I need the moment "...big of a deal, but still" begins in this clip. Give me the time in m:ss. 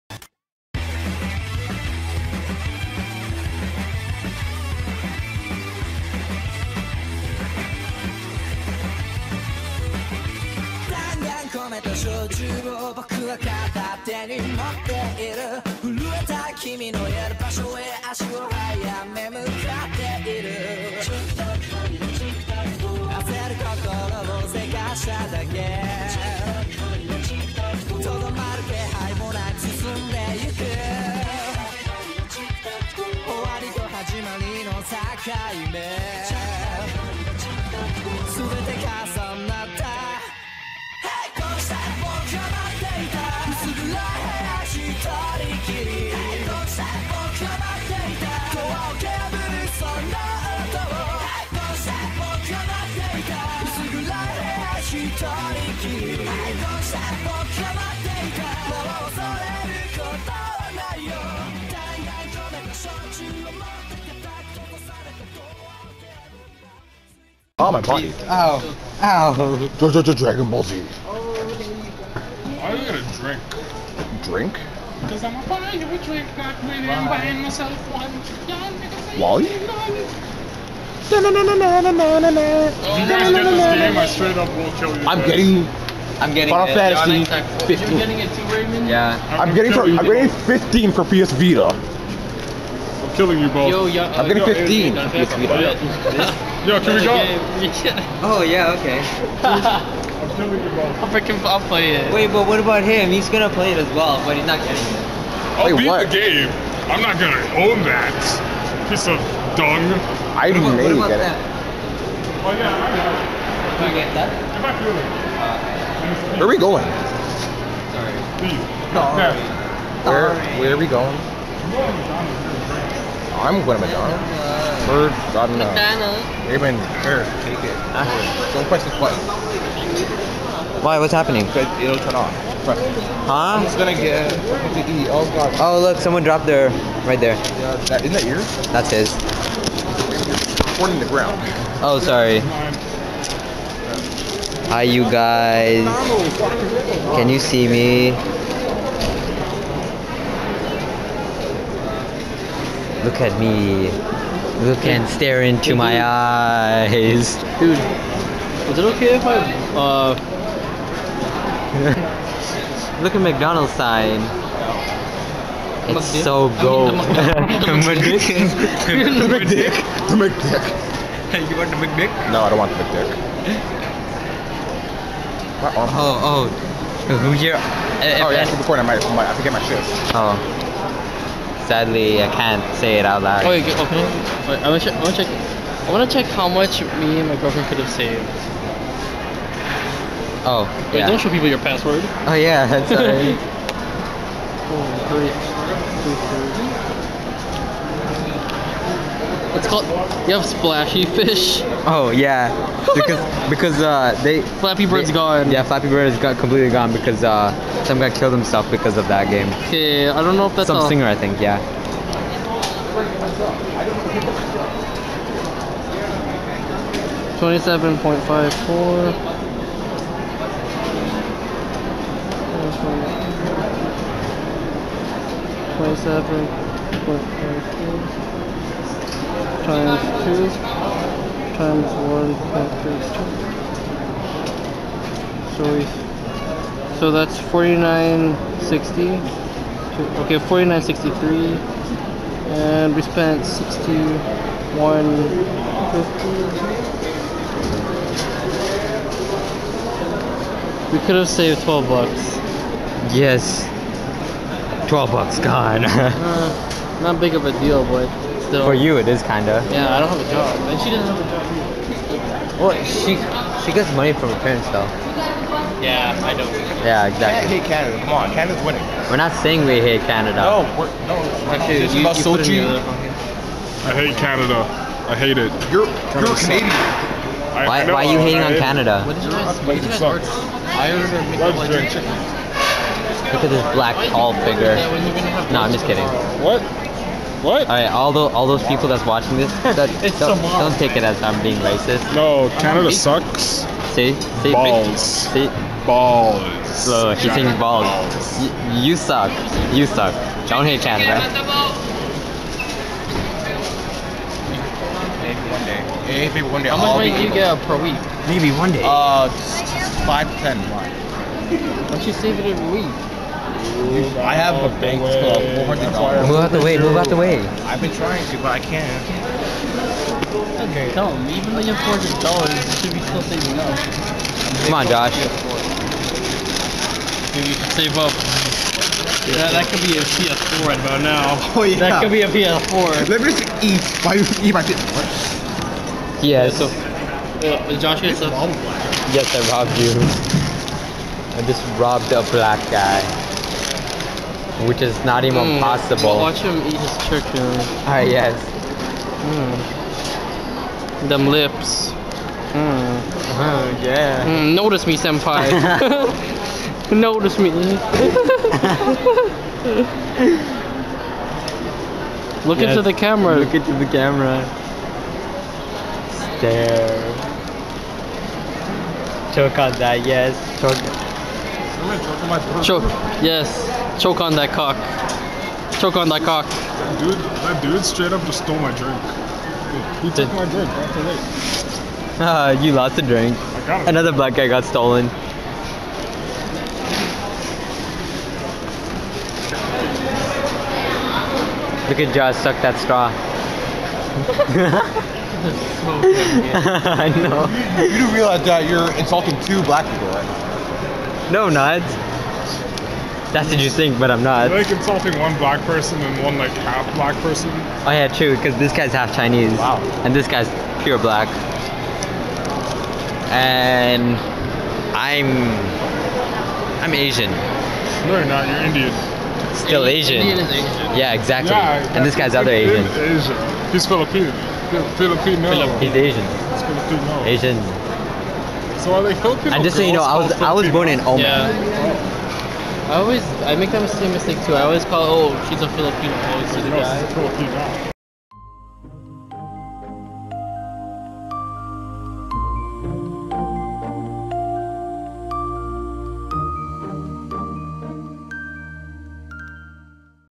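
4:17.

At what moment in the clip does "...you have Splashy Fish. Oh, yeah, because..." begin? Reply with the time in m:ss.
3:20.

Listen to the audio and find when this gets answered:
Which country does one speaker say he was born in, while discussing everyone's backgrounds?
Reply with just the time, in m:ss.
7:11.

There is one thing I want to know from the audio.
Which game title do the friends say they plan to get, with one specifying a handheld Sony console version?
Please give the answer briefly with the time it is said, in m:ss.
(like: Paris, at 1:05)
Final Fantasy 15, at 1:26.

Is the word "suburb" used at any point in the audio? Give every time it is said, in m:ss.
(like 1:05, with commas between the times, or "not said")
not said.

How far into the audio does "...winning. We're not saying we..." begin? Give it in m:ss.
4:28.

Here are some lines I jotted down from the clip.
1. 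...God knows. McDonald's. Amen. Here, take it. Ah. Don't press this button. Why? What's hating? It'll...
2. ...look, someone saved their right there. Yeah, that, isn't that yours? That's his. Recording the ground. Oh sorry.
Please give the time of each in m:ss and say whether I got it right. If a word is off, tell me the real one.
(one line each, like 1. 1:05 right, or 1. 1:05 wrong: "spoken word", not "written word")
1. 2:05 wrong: "happening", not "hating"
2. 2:15 wrong: "dropped", not "saved".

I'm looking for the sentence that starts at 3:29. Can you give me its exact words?
Okay, I don't know if that's Some singer, I think, yeah.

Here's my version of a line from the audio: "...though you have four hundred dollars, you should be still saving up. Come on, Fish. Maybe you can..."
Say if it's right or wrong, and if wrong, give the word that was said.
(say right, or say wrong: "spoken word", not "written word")
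wrong: "Josh", not "Fish".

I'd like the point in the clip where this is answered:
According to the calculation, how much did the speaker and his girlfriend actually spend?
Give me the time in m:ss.
4:03.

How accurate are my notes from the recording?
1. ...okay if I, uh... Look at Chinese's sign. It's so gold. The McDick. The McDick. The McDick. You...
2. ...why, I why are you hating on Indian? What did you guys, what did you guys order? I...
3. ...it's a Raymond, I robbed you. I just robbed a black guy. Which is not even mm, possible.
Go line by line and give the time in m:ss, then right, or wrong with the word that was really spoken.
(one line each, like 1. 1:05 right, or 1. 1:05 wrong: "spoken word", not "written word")
1. 2:38 wrong: "McDonald", not "Chinese"
2. 4:37 wrong: "Canada", not "Indian"
3. 5:38 wrong: "Yes", not "Raymond".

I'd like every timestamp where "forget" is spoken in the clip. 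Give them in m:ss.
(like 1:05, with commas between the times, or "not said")
2:59.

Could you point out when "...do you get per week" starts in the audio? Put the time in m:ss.
5:07.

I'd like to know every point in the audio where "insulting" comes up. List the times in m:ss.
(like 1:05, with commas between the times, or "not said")
6:38, 6:44.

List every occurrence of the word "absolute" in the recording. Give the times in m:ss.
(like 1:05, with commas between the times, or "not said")
not said.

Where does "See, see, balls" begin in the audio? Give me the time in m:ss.
4:53.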